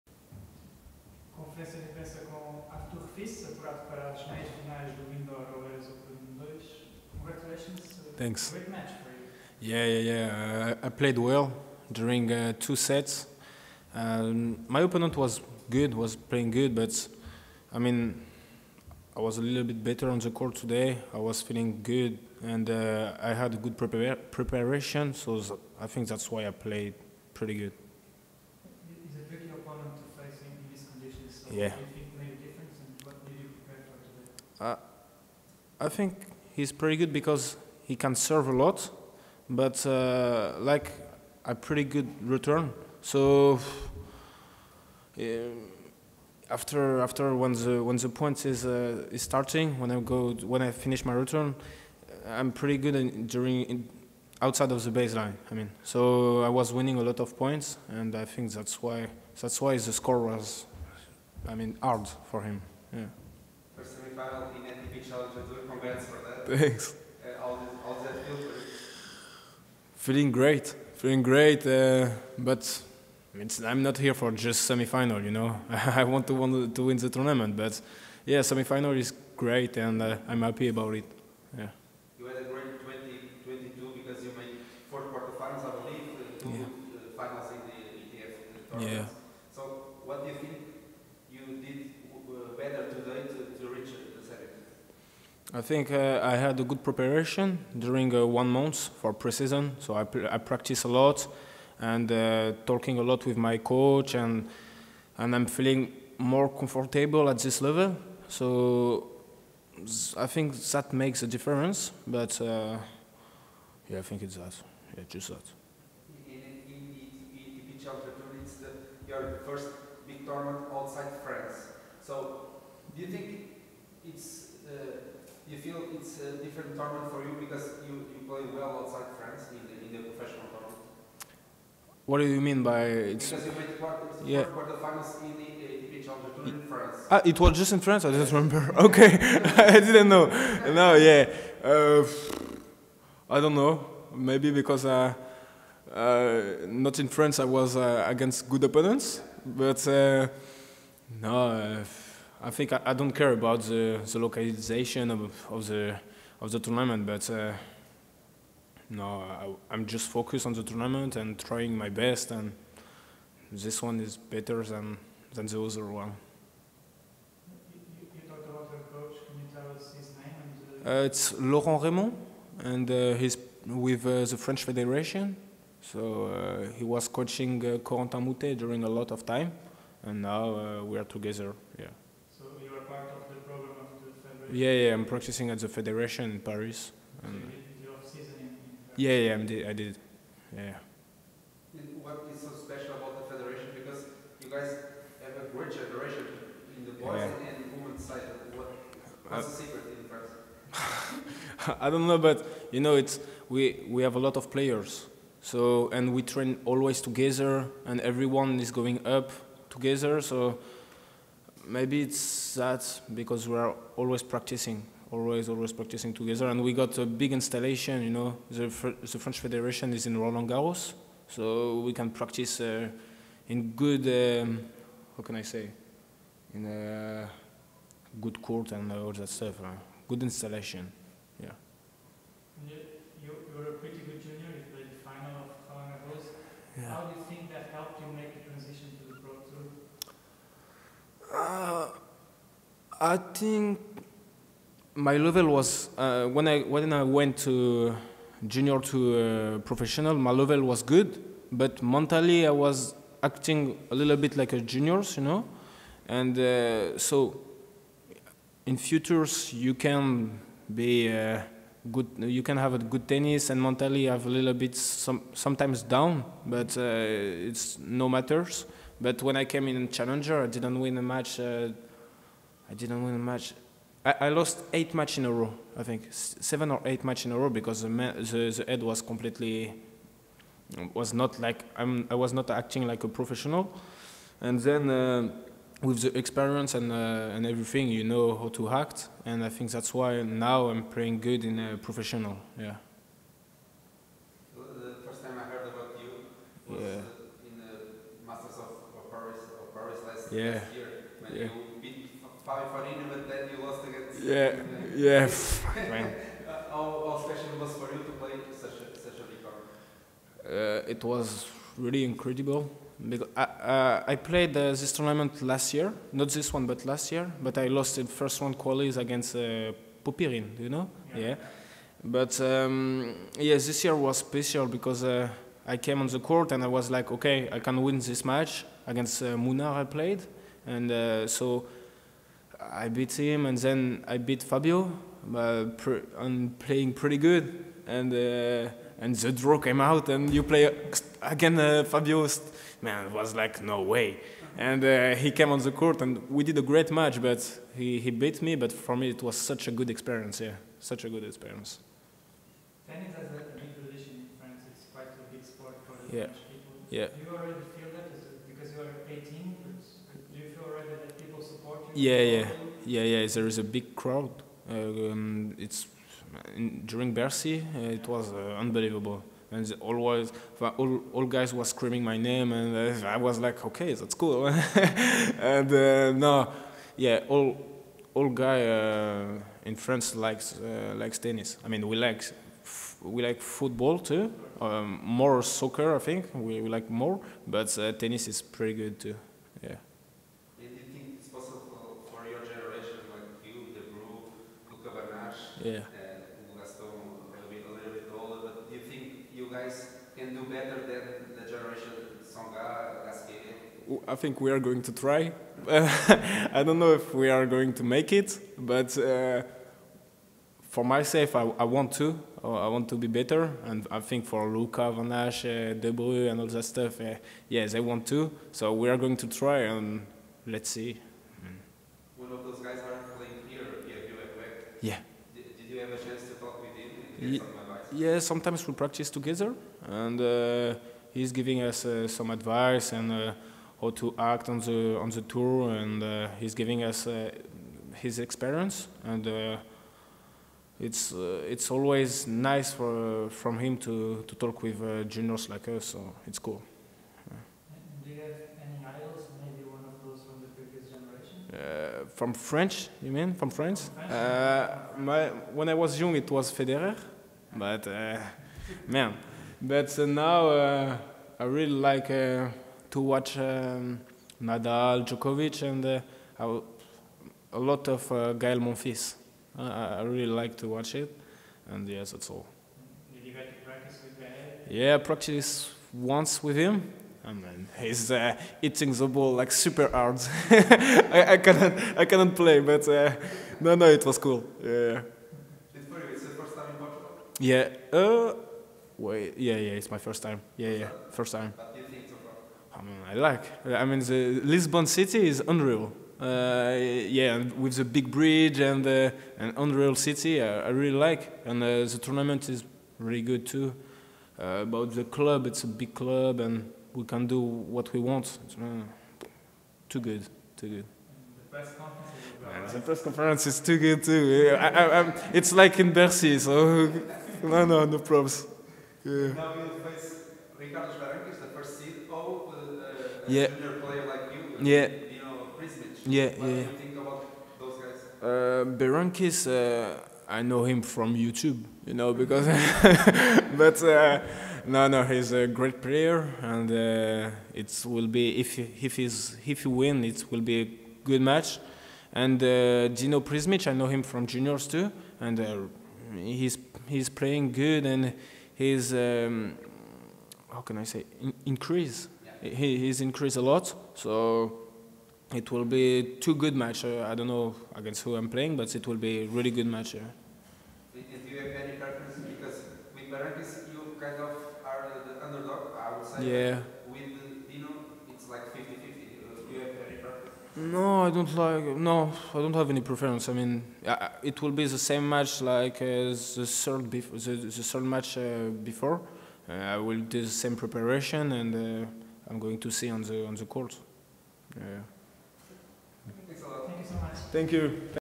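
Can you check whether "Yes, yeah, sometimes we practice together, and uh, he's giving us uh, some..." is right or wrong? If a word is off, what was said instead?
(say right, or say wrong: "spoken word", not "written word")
right.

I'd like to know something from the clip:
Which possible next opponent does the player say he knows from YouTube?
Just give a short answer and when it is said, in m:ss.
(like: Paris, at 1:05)
Berankis, at 8:48.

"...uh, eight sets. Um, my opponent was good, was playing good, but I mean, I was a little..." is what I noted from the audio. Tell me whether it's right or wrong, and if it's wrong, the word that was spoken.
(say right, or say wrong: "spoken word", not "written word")
wrong: "two", not "eight".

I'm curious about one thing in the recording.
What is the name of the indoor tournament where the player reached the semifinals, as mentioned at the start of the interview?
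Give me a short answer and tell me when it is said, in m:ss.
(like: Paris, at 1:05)
Indoor Oeiras Open 2, at 0:05.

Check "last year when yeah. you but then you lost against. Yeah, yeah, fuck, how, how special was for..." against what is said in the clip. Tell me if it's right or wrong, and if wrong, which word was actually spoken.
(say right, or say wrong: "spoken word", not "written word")
right.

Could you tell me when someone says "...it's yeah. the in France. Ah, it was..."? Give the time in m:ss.
2:14.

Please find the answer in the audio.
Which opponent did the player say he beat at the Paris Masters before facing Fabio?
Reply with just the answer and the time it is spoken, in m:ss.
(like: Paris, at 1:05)
Munar, at 5:29.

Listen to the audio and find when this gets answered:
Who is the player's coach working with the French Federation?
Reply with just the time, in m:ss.
2:51.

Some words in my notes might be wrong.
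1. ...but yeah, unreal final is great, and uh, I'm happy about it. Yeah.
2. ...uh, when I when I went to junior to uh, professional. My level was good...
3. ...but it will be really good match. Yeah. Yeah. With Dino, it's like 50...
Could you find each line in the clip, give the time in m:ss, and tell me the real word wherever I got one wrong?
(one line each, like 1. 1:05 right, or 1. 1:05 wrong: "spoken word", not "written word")
1. 1:17 wrong: "semifinal", not "unreal"
2. 4:05 right
3. 9:18 right.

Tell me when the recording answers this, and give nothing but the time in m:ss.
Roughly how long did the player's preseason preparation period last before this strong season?
1:38.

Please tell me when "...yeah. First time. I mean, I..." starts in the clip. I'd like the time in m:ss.
8:10.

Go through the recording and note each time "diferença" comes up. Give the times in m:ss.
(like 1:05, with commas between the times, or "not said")
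0:01.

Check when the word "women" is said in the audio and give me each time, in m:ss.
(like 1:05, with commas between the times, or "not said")
3:17.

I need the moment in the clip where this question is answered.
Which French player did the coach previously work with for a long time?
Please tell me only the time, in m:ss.
2:57.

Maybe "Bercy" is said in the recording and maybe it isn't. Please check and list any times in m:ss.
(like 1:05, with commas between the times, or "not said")
6:07, 8:35.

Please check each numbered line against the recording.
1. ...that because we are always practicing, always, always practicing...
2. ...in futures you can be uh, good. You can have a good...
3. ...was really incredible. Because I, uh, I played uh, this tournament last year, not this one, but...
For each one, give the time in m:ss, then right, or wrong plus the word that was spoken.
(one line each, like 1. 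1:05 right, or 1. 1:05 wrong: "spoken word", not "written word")
1. 3:32 right
2. 4:18 right
3. 5:11 right.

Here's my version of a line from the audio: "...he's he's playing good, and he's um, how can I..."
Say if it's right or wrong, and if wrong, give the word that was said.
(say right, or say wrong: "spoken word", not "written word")
right.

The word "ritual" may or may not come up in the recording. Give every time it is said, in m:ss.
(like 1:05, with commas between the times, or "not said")
not said.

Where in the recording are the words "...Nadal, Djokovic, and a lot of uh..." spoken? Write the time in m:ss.
7:44.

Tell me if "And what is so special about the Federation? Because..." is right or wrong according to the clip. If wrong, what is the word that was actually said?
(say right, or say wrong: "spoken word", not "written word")
right.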